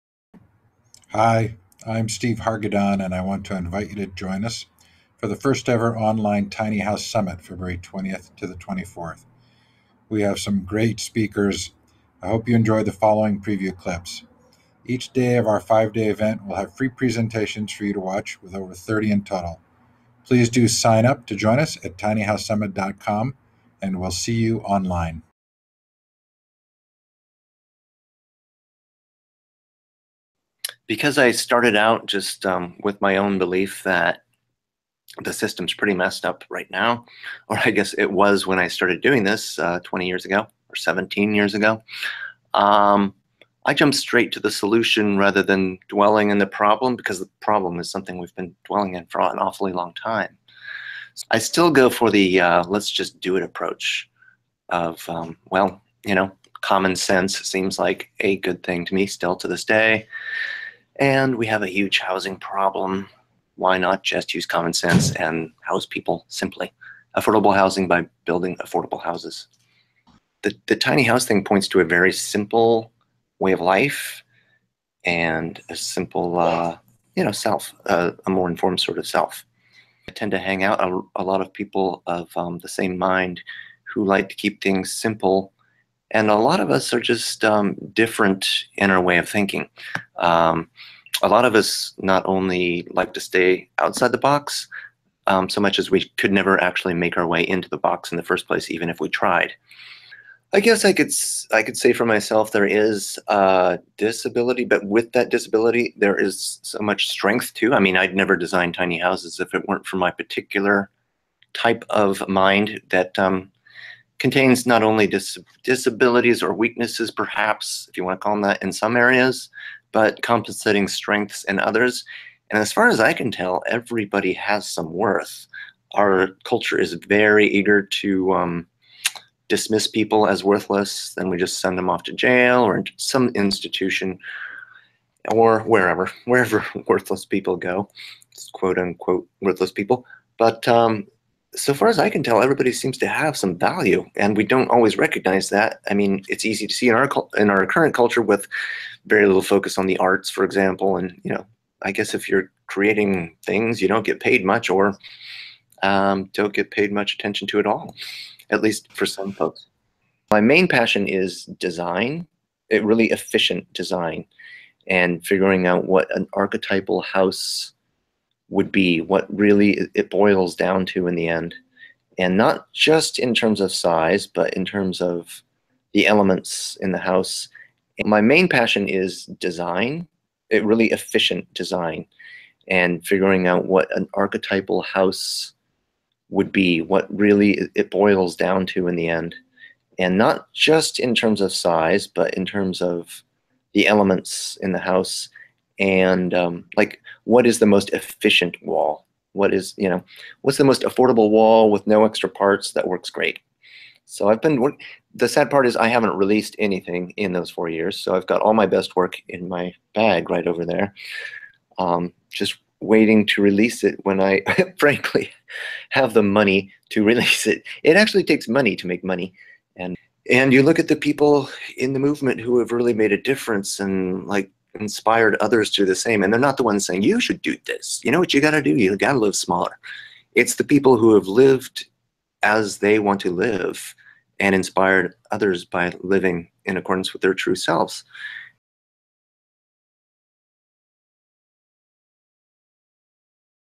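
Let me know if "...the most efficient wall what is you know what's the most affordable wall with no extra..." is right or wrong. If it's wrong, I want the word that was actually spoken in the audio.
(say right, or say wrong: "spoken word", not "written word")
right.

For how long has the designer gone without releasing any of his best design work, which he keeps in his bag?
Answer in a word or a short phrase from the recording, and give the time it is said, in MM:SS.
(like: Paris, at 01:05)
4 years, at 03:27.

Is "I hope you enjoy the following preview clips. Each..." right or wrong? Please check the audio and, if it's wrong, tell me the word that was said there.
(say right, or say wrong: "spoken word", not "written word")
right.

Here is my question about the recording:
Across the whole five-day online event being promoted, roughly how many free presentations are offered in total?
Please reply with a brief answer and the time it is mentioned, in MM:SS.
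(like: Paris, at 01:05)
over 30, at 00:18.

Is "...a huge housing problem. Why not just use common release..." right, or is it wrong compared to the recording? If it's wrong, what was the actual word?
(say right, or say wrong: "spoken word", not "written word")
wrong: "sense", not "release".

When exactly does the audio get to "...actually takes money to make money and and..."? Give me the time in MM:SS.
03:37.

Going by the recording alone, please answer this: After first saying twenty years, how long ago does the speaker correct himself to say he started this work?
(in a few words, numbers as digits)
17 years ago.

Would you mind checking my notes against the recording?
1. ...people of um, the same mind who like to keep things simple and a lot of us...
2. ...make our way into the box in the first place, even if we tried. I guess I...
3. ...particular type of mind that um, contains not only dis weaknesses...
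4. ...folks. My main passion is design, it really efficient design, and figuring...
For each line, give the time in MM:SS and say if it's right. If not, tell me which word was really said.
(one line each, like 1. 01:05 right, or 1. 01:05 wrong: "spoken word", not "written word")
1. 01:21 right
2. 01:36 right
3. 01:50 wrong: "disabilities", not "weaknesses"
4. 02:39 right.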